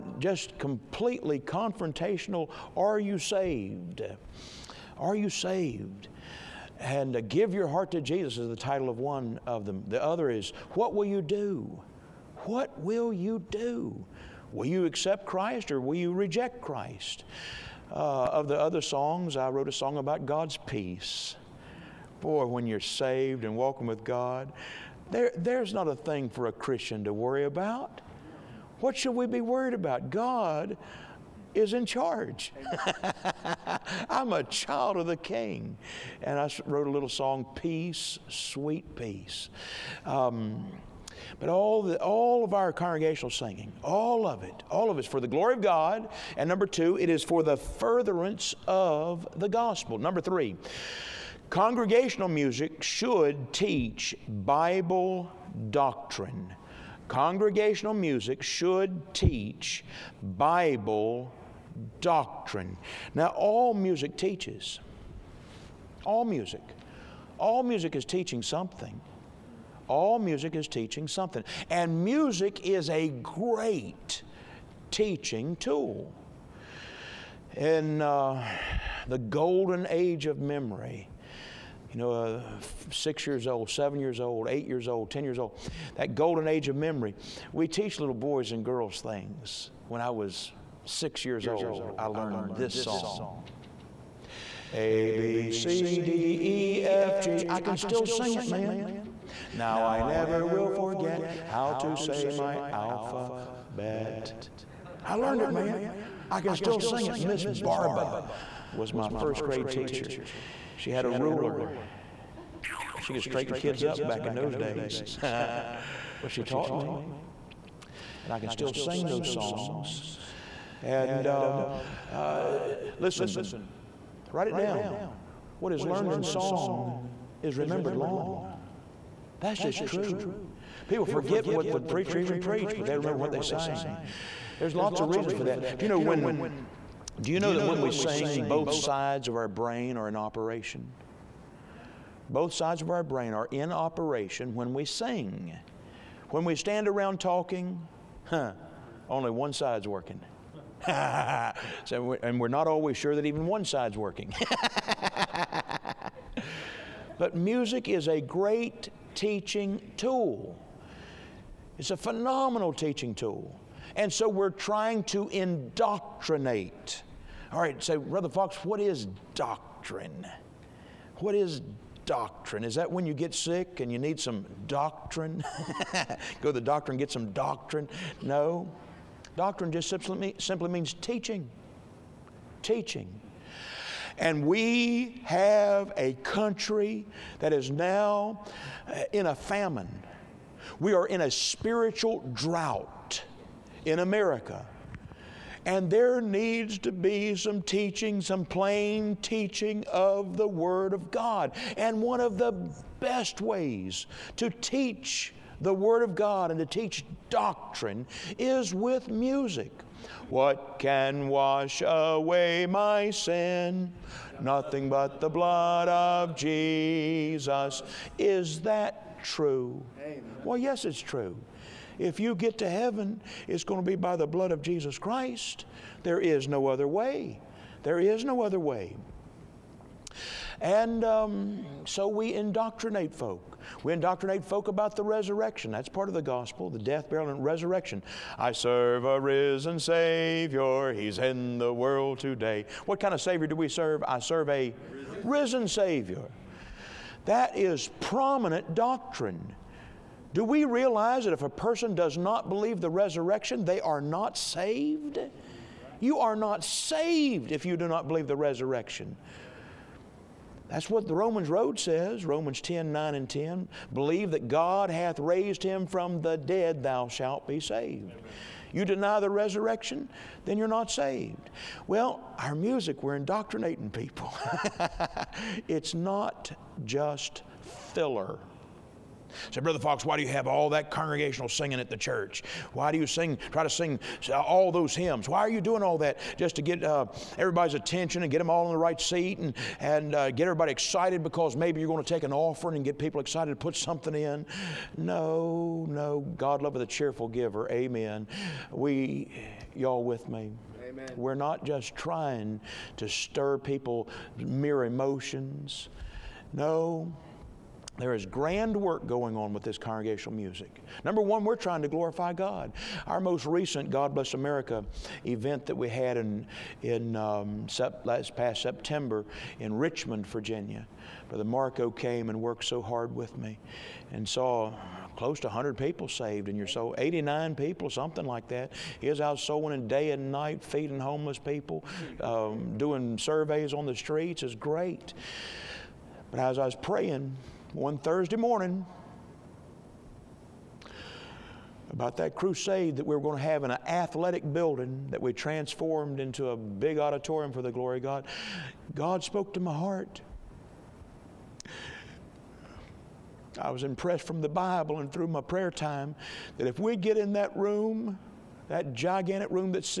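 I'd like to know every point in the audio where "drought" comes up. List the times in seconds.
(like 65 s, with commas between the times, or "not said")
192 s.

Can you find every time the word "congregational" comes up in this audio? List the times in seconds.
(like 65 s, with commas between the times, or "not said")
42 s, 51 s, 57 s, 280 s, 309 s.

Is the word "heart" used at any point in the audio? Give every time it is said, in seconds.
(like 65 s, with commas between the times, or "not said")
7 s, 349 s.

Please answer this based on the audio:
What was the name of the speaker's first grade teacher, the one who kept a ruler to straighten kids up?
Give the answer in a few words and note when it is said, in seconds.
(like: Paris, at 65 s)
Miss Barba, at 107 s.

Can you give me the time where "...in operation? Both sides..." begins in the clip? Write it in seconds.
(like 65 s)
140 s.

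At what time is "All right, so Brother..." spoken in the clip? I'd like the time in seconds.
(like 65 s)
167 s.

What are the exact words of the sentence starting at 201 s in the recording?
And one of the best ways to teach the Word of God and to teach doctrine is with music.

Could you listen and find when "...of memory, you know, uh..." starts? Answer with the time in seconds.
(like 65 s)
80 s.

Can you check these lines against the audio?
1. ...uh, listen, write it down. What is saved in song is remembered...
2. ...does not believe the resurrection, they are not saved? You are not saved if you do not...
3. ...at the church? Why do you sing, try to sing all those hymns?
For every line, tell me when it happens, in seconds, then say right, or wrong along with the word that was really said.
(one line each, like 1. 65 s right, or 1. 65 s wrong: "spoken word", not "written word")
1. 122 s wrong: "learned", not "saved"
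2. 251 s right
3. 281 s right.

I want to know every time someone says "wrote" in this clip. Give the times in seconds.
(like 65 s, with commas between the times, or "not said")
19 s, 36 s.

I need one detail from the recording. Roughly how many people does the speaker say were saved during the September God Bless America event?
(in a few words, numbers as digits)
89.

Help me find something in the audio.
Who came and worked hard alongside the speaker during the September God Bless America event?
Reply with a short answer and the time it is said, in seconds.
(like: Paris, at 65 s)
Brother Marco, at 321 s.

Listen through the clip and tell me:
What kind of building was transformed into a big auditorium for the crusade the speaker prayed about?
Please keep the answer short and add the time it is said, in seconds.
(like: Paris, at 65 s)
An athletic building, at 343 s.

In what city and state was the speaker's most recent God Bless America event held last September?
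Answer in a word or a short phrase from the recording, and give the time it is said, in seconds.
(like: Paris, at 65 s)
Richmond, Virginia, at 319 s.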